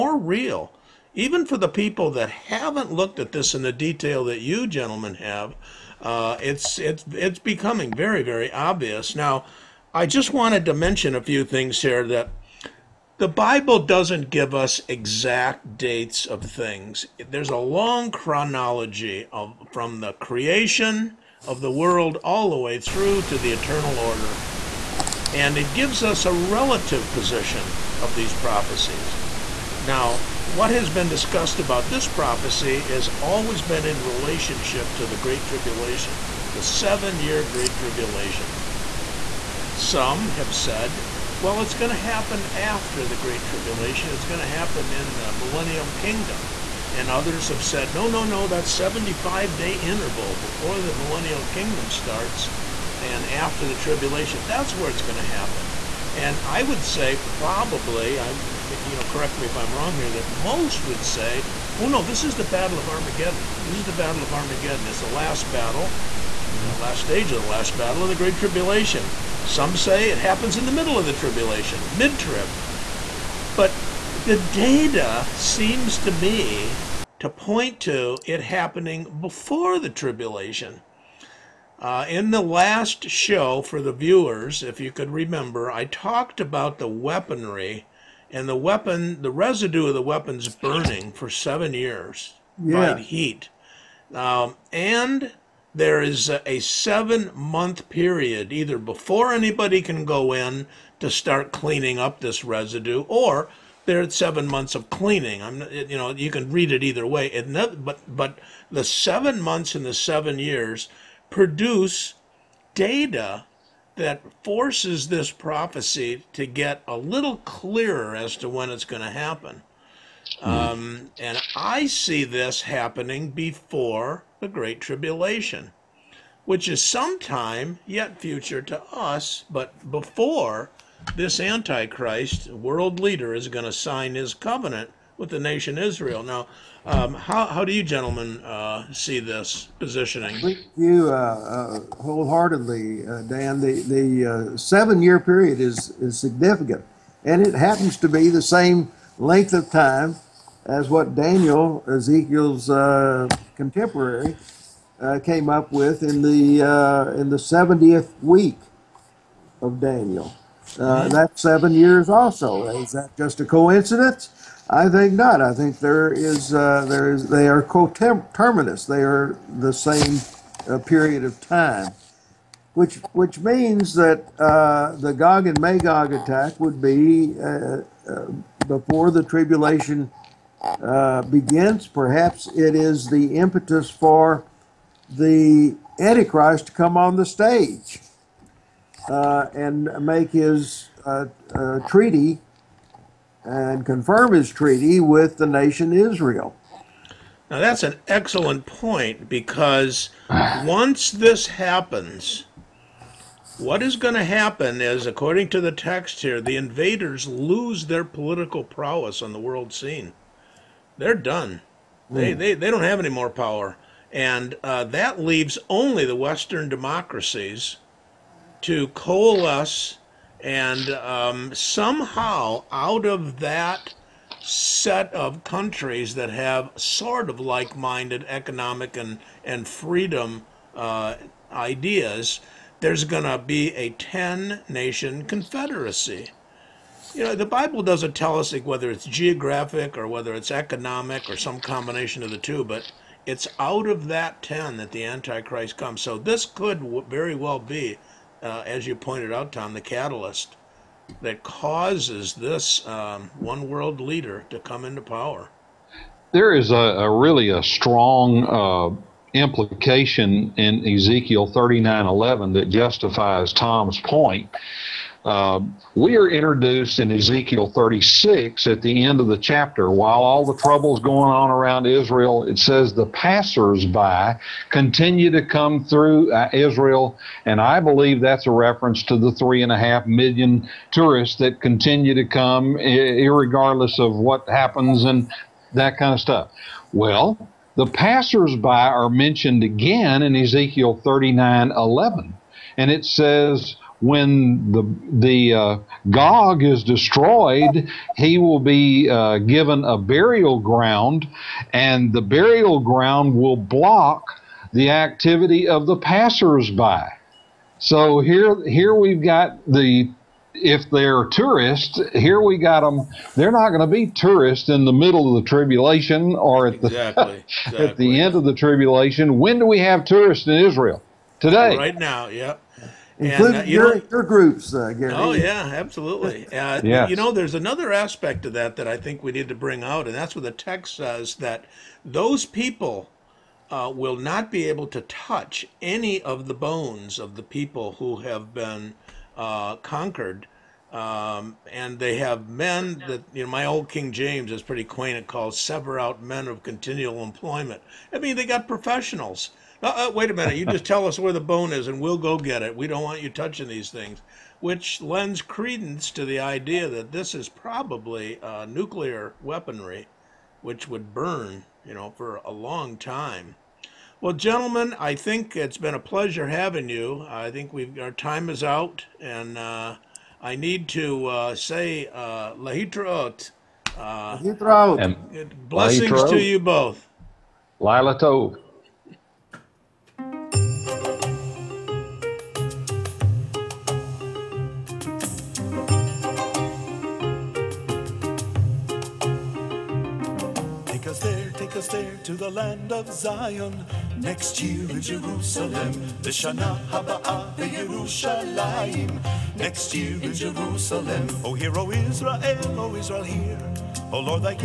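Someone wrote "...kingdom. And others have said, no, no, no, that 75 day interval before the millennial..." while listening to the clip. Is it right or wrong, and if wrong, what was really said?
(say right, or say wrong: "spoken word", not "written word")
right.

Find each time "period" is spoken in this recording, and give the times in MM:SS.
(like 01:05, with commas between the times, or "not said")
01:37, 02:25, 02:50.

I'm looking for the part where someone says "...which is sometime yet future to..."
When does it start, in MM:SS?
02:06.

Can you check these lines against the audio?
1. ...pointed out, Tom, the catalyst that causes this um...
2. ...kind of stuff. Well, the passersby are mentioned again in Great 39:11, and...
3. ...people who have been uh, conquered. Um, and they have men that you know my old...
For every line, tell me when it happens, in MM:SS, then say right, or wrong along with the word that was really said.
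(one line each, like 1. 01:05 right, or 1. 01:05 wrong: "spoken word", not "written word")
1. 04:08 right
2. 04:45 wrong: "Ezekiel", not "Great"
3. 05:37 right.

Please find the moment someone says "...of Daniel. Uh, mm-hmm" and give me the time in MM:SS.
02:39.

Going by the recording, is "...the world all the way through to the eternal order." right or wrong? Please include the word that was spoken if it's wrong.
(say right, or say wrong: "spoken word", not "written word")
right.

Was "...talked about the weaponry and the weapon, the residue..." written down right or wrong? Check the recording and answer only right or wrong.
right.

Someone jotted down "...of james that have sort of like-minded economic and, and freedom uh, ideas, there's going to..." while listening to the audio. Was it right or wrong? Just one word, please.
wrong.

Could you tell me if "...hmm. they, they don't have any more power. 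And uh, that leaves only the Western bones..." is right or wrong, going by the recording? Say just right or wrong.
wrong.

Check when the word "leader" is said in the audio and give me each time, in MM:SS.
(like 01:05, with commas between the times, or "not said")
02:12, 04:14.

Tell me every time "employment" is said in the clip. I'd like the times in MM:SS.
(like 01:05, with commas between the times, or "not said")
05:47.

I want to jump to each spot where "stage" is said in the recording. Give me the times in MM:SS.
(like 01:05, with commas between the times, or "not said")
01:07, 03:07.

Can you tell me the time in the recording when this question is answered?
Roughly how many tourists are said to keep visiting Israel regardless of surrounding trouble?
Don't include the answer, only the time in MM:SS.
04:39.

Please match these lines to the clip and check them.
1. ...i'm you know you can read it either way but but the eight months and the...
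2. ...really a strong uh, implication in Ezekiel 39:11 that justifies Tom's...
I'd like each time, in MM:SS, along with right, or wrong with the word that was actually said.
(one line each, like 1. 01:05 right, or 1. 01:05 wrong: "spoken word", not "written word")
1. 01:45 wrong: "seven", not "eight"
2. 04:17 right.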